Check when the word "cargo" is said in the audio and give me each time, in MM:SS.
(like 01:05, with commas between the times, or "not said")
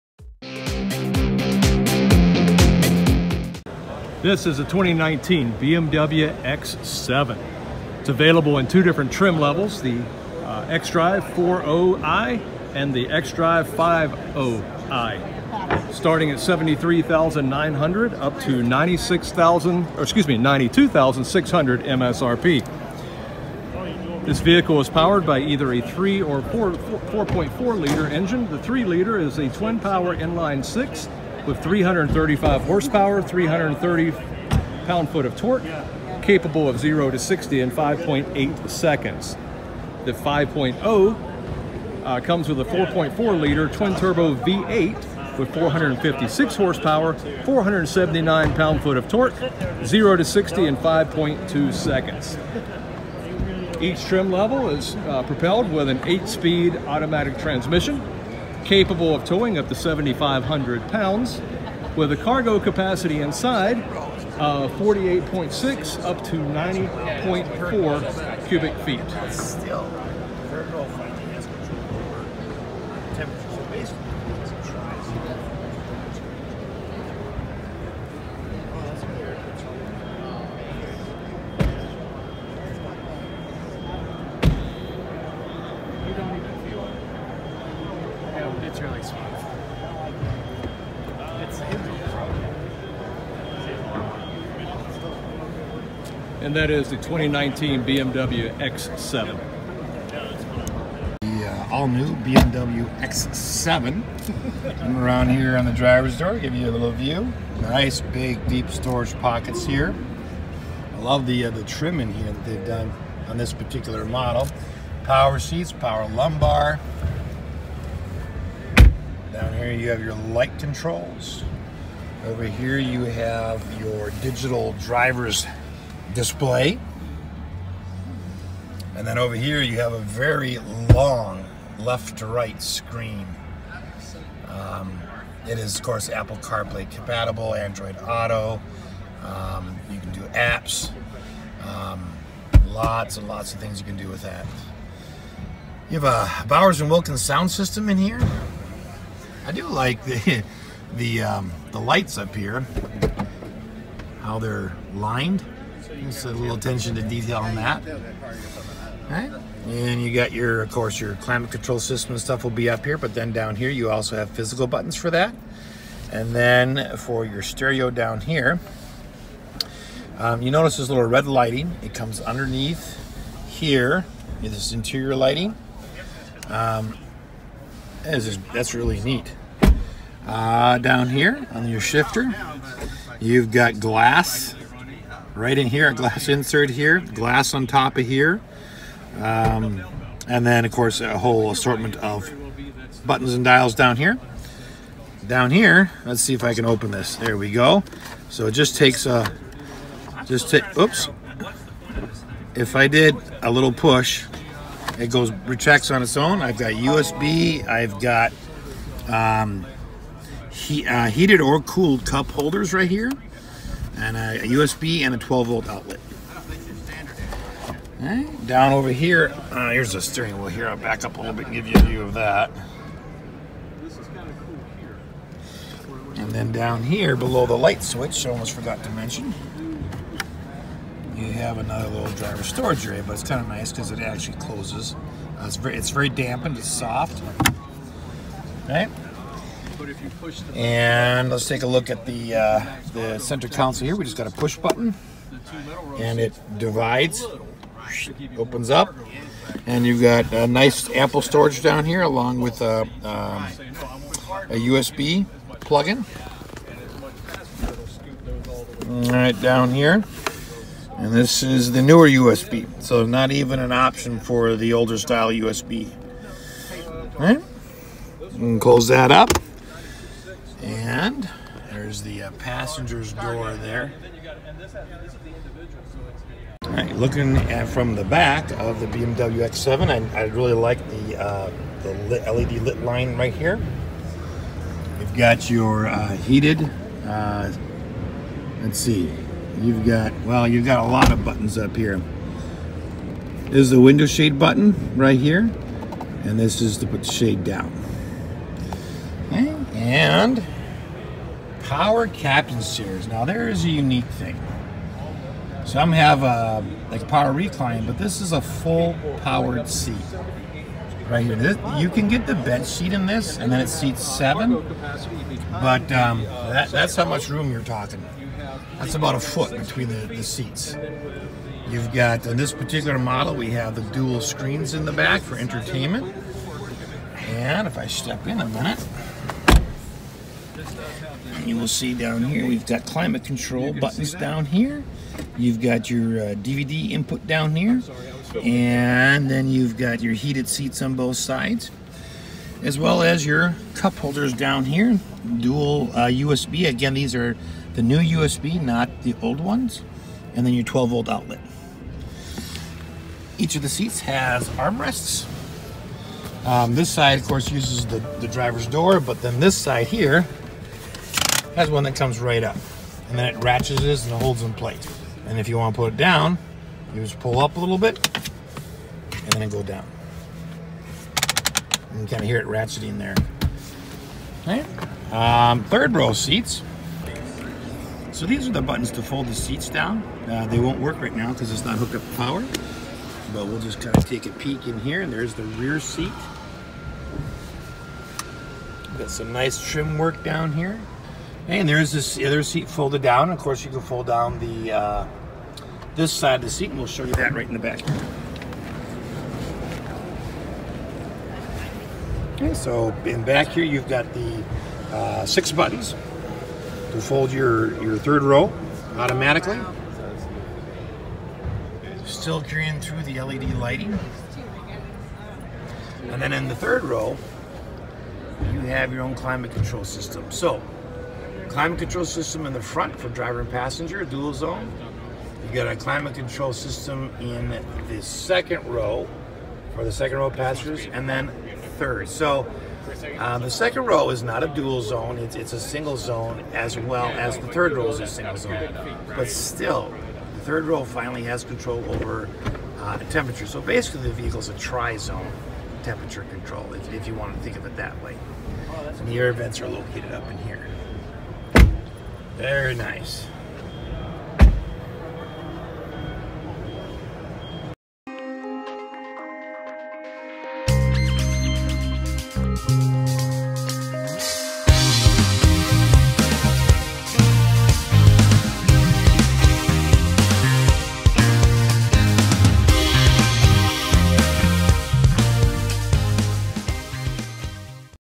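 01:02.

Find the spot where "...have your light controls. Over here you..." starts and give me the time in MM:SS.
01:59.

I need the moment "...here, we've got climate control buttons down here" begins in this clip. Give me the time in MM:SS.
05:32.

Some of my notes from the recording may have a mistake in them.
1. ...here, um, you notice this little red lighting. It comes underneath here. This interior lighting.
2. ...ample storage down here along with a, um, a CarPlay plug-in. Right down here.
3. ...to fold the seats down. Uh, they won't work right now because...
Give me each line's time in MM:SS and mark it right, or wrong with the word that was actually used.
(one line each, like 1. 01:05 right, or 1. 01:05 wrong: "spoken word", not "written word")
1. 02:48 right
2. 04:10 wrong: "USB", not "CarPlay"
3. 06:18 right.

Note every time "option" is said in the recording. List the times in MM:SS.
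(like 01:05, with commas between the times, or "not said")
04:23.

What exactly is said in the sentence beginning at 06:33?
Of course, you can fold down the uh, this side of the seat, and we'll show you that right in the back.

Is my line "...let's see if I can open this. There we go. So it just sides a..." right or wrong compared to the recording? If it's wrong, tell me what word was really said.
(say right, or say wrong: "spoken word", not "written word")
wrong: "takes", not "sides".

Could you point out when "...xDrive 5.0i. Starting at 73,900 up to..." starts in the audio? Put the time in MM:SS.
00:13.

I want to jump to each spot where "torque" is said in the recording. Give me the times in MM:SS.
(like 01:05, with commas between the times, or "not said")
00:35, 00:49.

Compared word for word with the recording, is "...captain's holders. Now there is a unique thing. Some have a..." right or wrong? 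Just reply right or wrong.
wrong.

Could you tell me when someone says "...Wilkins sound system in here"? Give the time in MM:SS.
02:26.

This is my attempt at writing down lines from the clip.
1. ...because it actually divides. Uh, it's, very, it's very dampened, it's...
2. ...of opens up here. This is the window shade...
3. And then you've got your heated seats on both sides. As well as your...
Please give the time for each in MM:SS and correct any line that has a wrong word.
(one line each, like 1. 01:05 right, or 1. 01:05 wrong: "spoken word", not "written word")
1. 03:53 wrong: "closes", not "divides"
2. 04:51 wrong: "buttons", not "opens"
3. 05:38 right.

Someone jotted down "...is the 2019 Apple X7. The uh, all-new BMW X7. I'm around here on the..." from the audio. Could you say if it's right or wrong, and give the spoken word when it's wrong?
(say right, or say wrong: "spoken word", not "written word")
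wrong: "BMW", not "Apple".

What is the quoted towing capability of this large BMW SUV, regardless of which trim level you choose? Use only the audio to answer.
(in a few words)
7,500 pounds.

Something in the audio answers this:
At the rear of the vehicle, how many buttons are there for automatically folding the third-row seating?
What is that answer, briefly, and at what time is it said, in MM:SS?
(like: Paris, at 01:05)
6, at 06:45.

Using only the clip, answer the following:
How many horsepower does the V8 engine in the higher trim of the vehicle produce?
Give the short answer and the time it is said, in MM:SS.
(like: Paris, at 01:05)
456, at 00:45.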